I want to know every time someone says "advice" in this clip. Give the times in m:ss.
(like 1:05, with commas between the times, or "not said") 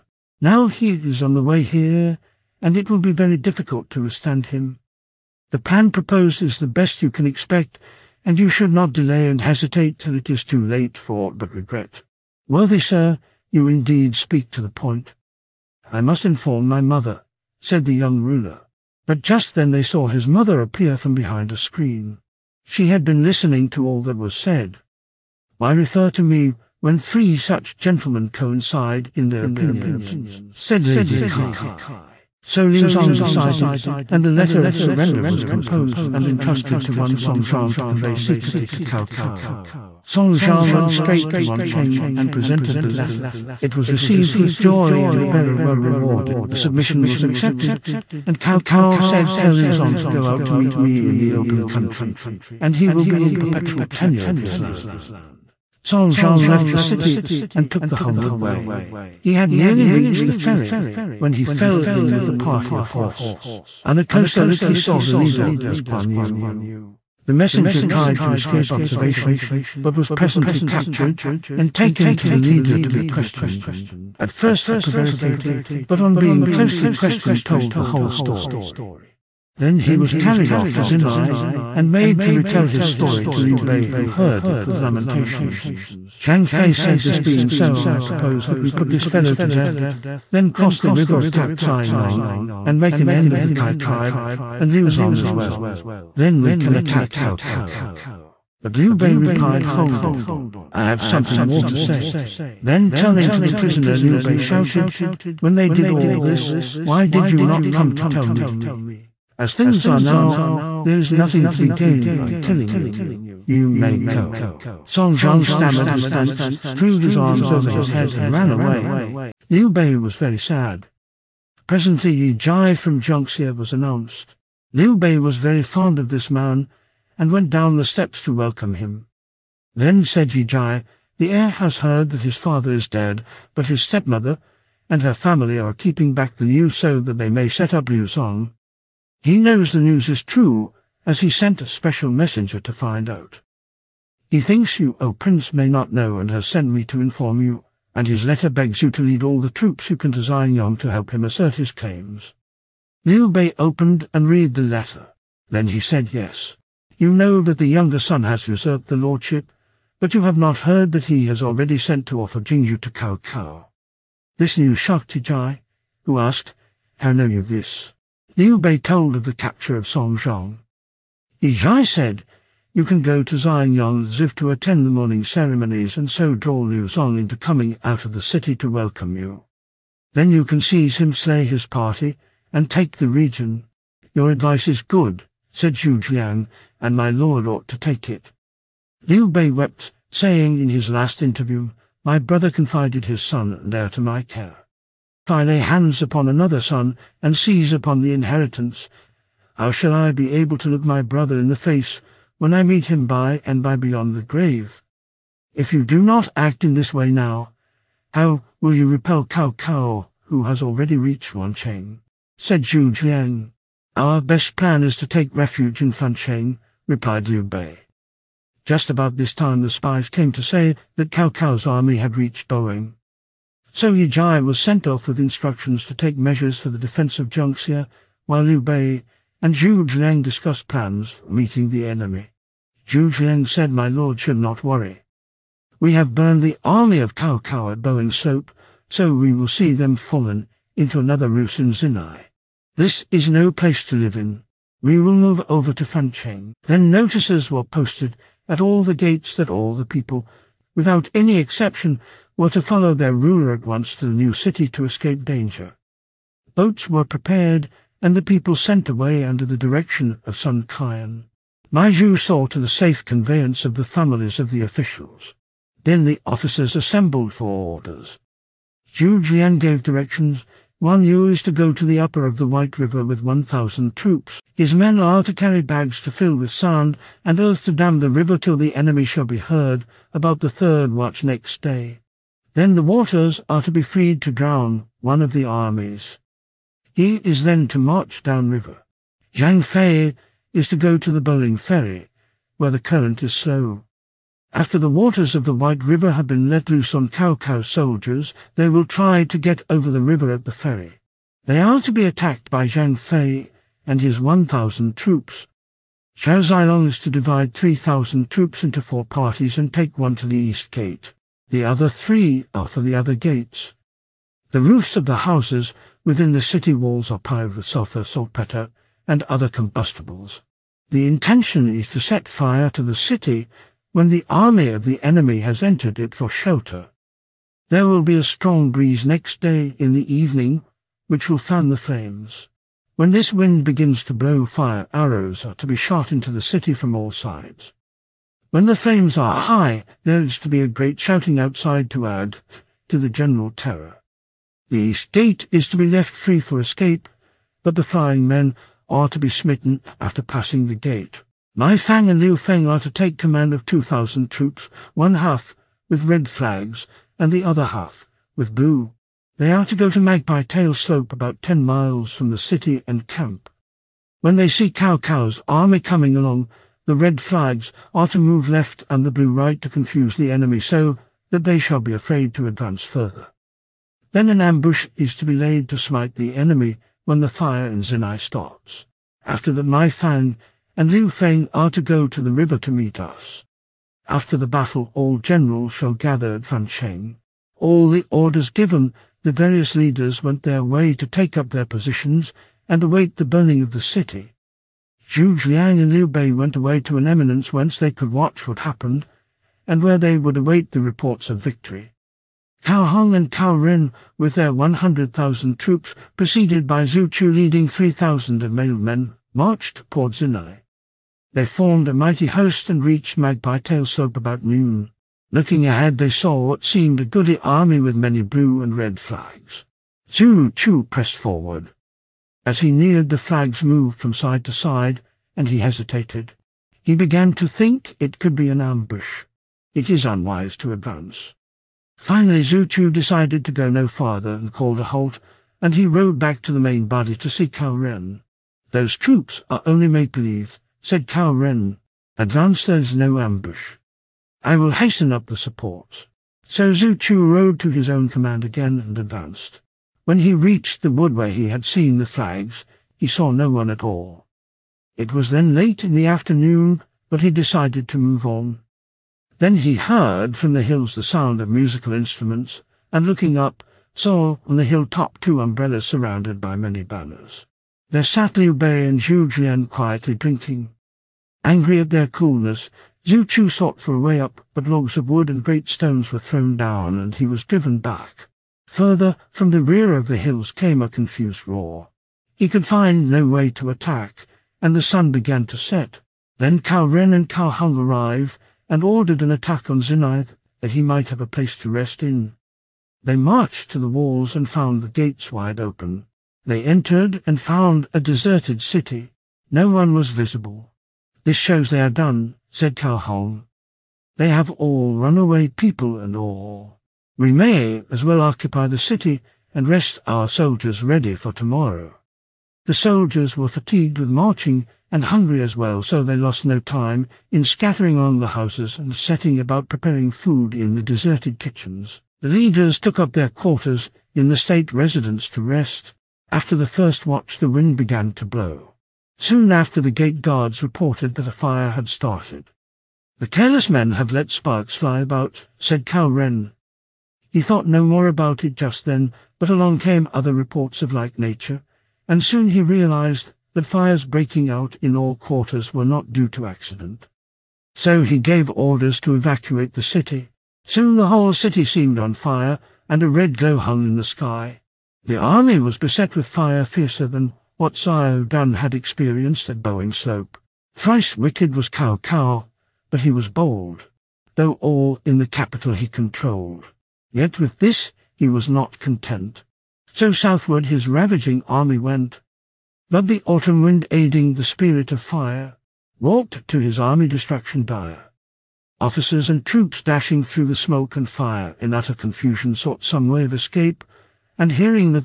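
3:04.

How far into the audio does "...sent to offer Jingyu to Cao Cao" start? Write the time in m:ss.
2:41.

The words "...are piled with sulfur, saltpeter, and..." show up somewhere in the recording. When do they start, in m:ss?
5:17.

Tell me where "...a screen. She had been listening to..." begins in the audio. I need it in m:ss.
0:21.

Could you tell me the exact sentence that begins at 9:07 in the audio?
So he gave orders to evacuate the city.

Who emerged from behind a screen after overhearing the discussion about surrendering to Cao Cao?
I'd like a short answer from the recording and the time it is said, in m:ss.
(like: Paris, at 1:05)
Lady Kai, at 0:30.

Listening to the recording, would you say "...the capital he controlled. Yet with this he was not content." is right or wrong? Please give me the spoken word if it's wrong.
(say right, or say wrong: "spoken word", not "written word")
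right.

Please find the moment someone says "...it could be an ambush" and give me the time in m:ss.
7:07.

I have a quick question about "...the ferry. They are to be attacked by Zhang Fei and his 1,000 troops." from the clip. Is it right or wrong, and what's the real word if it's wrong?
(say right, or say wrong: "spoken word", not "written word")
right.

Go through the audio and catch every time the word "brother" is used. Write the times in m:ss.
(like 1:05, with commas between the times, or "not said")
3:12, 3:21.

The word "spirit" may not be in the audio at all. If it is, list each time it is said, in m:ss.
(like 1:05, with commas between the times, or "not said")
9:34.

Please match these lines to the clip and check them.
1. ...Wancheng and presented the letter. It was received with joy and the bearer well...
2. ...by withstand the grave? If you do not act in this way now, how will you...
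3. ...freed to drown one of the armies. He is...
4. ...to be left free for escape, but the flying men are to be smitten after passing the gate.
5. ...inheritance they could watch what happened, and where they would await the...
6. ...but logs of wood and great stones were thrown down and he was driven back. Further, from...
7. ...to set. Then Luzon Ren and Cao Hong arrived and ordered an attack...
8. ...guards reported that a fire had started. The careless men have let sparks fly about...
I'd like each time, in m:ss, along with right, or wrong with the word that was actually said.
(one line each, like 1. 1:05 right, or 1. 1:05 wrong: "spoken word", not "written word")
1. 0:41 right
2. 3:23 wrong: "beyond", not "withstand"
3. 4:43 right
4. 5:45 right
5. 6:37 wrong: "whence", not "inheritance"
6. 7:54 right
7. 8:05 wrong: "Cao", not "Luzon"
8. 8:50 right.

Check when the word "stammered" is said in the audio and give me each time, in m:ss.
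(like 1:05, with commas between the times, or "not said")
1:55.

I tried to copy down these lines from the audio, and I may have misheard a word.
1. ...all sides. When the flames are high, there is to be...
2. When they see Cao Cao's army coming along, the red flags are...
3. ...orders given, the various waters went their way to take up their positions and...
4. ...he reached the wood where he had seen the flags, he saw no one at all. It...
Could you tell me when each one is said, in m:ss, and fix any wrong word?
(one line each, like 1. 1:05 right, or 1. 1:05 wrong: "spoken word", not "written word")
1. 5:36 right
2. 6:04 right
3. 6:28 wrong: "leaders", not "waters"
4. 7:30 right.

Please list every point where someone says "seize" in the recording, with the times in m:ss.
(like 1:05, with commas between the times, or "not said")
3:00, 3:17.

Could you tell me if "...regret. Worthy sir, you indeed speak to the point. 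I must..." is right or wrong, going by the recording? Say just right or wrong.
right.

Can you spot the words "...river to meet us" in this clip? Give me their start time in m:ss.
6:22.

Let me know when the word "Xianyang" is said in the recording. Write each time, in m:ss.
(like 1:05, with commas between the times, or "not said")
2:30, 2:53.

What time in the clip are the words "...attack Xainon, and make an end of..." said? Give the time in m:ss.
1:31.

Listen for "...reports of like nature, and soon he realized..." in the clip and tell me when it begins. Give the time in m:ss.
9:00.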